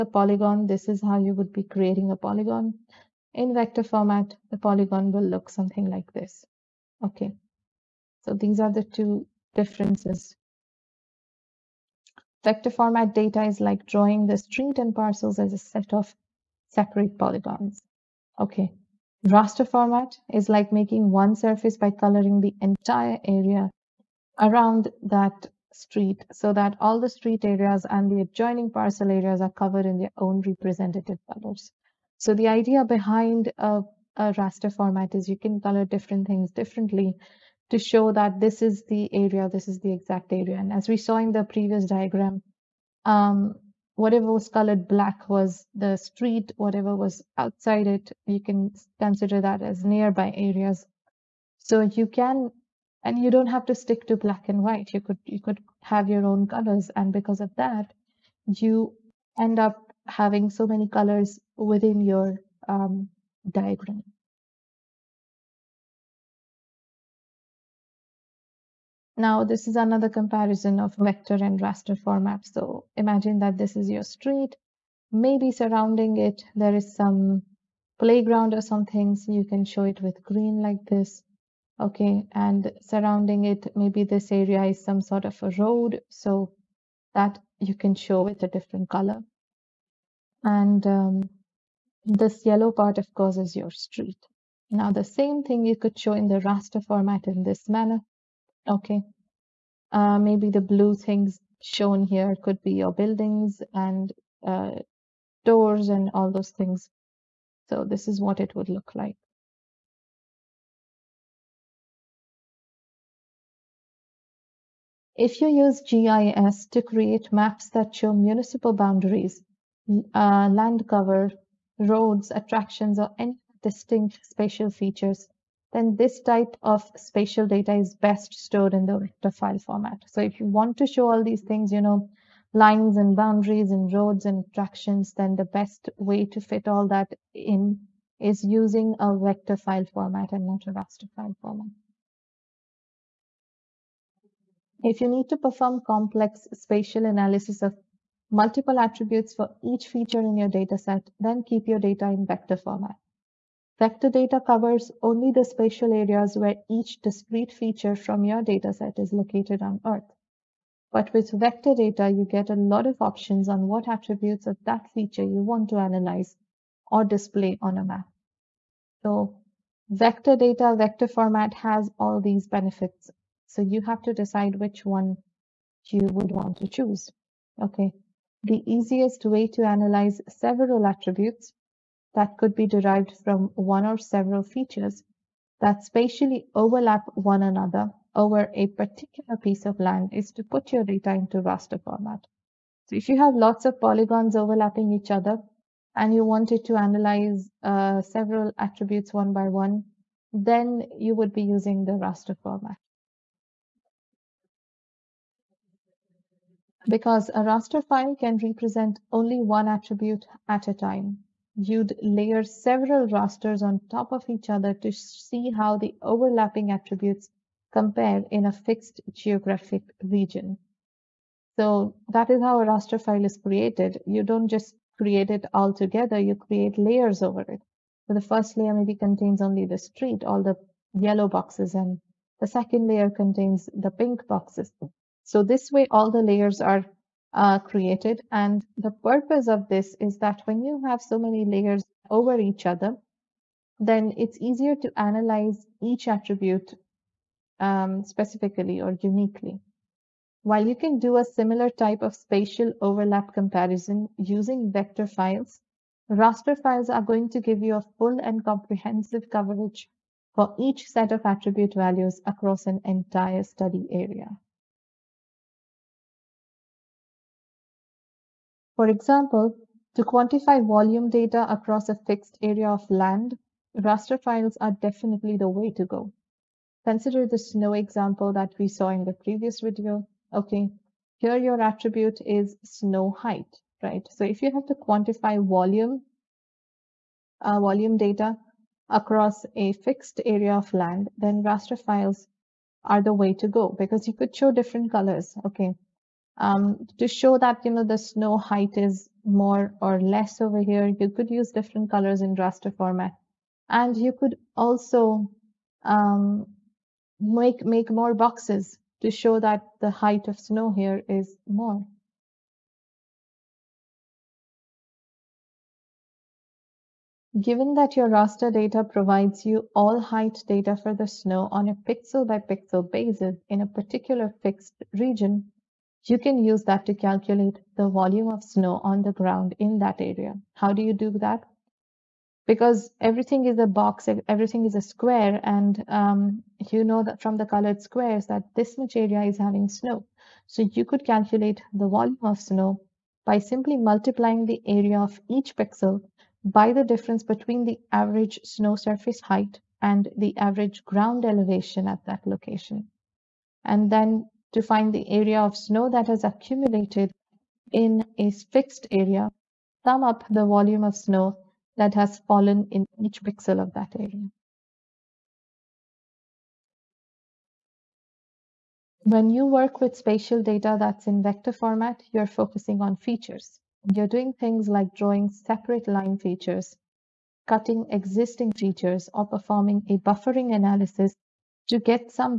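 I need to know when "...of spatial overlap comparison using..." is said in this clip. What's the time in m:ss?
4:12.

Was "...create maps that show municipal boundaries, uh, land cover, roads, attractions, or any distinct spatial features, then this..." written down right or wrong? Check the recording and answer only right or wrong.
right.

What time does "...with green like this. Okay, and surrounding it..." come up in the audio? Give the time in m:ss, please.
1:20.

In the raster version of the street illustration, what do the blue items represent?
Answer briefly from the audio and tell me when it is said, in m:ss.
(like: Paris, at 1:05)
Buildings, at 1:42.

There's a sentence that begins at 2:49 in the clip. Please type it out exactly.
So vector data, vector format has all these benefits.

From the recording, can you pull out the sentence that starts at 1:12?
So imagine that this is your street.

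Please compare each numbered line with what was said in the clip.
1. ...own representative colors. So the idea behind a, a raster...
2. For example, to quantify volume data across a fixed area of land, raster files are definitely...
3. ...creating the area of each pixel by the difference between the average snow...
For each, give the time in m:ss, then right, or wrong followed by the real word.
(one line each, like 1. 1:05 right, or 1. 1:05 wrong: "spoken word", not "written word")
1. 0:30 right
2. 4:28 right
3. 5:43 wrong: "multiplying", not "creating".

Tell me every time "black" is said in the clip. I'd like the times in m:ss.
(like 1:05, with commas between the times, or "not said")
0:44, 0:54.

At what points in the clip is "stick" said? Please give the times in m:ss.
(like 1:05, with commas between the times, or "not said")
0:53.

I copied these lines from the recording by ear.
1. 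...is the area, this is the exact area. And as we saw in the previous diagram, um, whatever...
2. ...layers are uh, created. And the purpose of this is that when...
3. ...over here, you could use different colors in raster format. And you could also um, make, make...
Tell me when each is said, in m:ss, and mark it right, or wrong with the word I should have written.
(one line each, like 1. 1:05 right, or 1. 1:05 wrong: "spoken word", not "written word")
1. 0:38 right
2. 3:56 right
3. 5:00 right.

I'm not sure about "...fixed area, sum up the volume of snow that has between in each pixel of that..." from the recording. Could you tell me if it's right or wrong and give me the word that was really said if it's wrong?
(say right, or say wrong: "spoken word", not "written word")
wrong: "fallen", not "between".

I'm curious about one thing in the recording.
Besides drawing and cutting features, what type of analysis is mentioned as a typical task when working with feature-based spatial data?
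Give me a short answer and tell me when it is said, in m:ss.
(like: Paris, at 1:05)
Buffering analysis, at 6:19.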